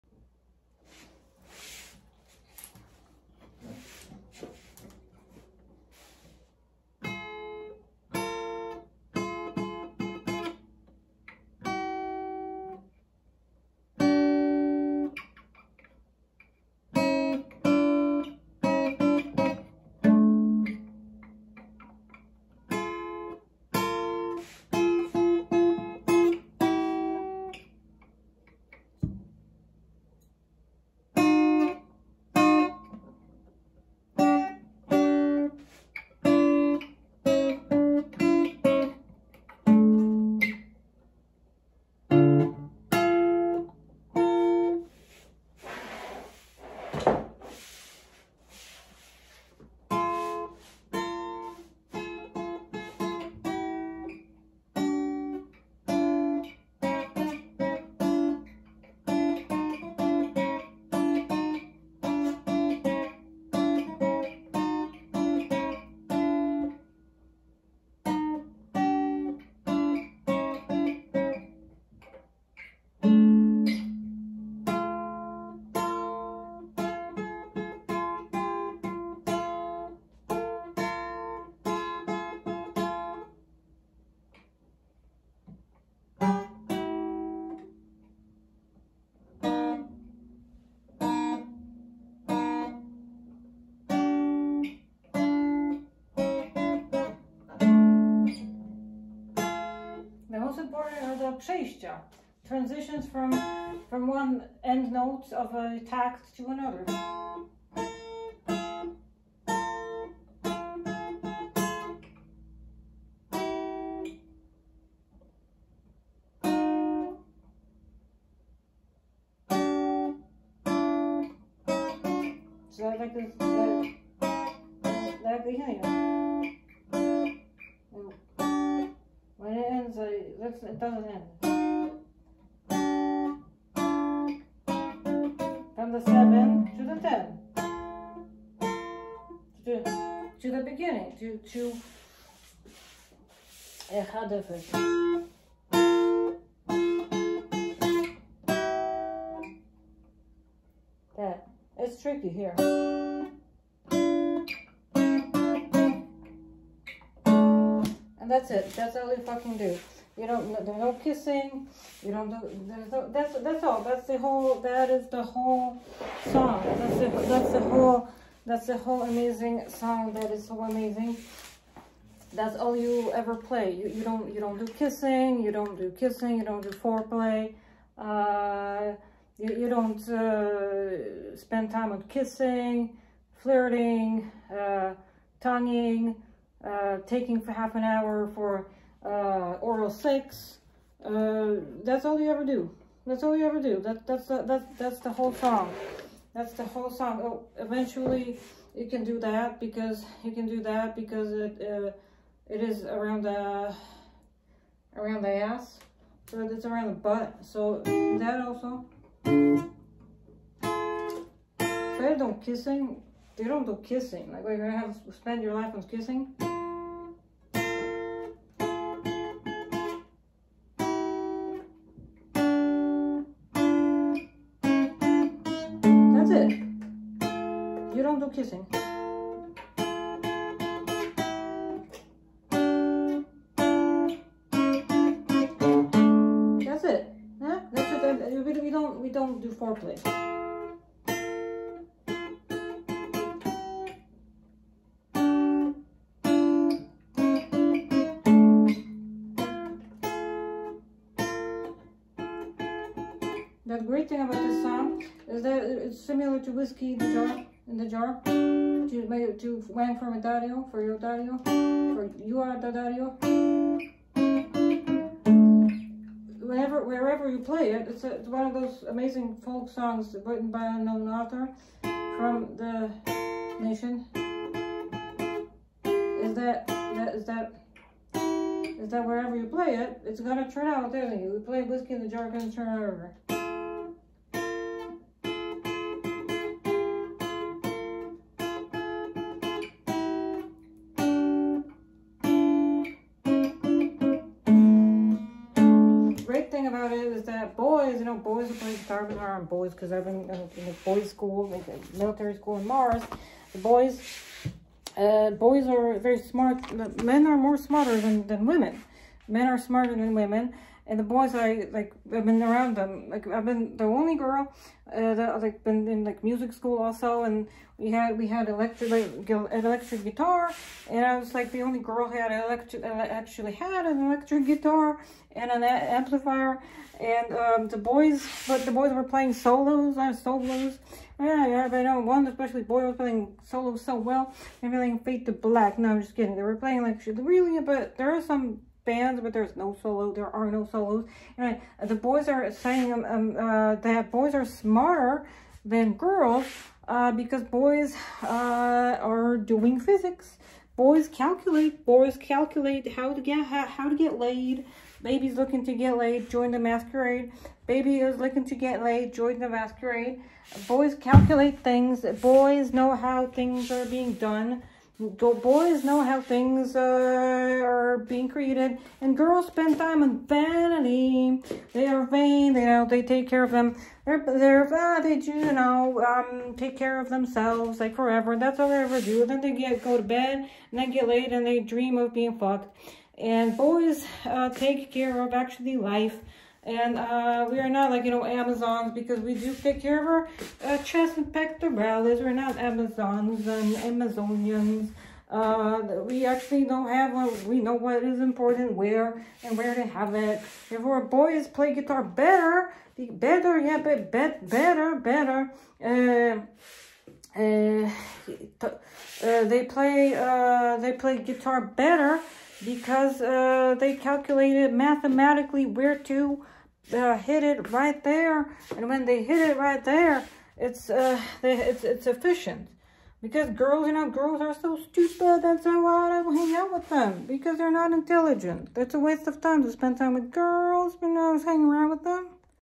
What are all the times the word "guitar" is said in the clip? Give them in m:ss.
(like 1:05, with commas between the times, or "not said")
4:58, 5:20, 5:24, 6:41, 6:51.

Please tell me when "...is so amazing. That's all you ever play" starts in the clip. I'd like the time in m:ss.
2:50.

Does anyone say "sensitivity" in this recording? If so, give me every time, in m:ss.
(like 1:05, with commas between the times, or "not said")
not said.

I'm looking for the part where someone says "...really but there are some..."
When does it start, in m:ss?
5:37.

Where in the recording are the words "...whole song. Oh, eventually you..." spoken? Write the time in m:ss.
3:16.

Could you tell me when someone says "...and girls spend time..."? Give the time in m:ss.
6:09.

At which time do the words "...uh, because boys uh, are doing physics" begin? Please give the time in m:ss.
5:46.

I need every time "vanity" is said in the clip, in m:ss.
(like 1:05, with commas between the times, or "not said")
6:10.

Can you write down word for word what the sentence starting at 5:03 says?
The boys, uh, boys are very smart.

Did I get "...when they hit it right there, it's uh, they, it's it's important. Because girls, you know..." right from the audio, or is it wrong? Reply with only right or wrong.
wrong.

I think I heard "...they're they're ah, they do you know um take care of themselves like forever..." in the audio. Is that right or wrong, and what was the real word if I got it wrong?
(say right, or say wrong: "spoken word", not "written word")
right.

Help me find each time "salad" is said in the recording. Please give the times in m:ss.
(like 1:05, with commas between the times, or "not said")
not said.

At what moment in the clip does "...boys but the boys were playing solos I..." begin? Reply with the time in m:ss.
5:27.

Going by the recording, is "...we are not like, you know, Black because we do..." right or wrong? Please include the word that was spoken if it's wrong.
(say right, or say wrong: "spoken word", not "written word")
wrong: "Amazons", not "Black".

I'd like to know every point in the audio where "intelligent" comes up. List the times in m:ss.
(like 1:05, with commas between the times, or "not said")
7:07.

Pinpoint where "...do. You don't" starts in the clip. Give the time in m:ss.
2:39.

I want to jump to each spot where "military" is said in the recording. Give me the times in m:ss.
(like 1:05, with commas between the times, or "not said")
5:01.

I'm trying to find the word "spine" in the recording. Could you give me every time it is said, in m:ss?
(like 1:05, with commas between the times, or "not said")
not said.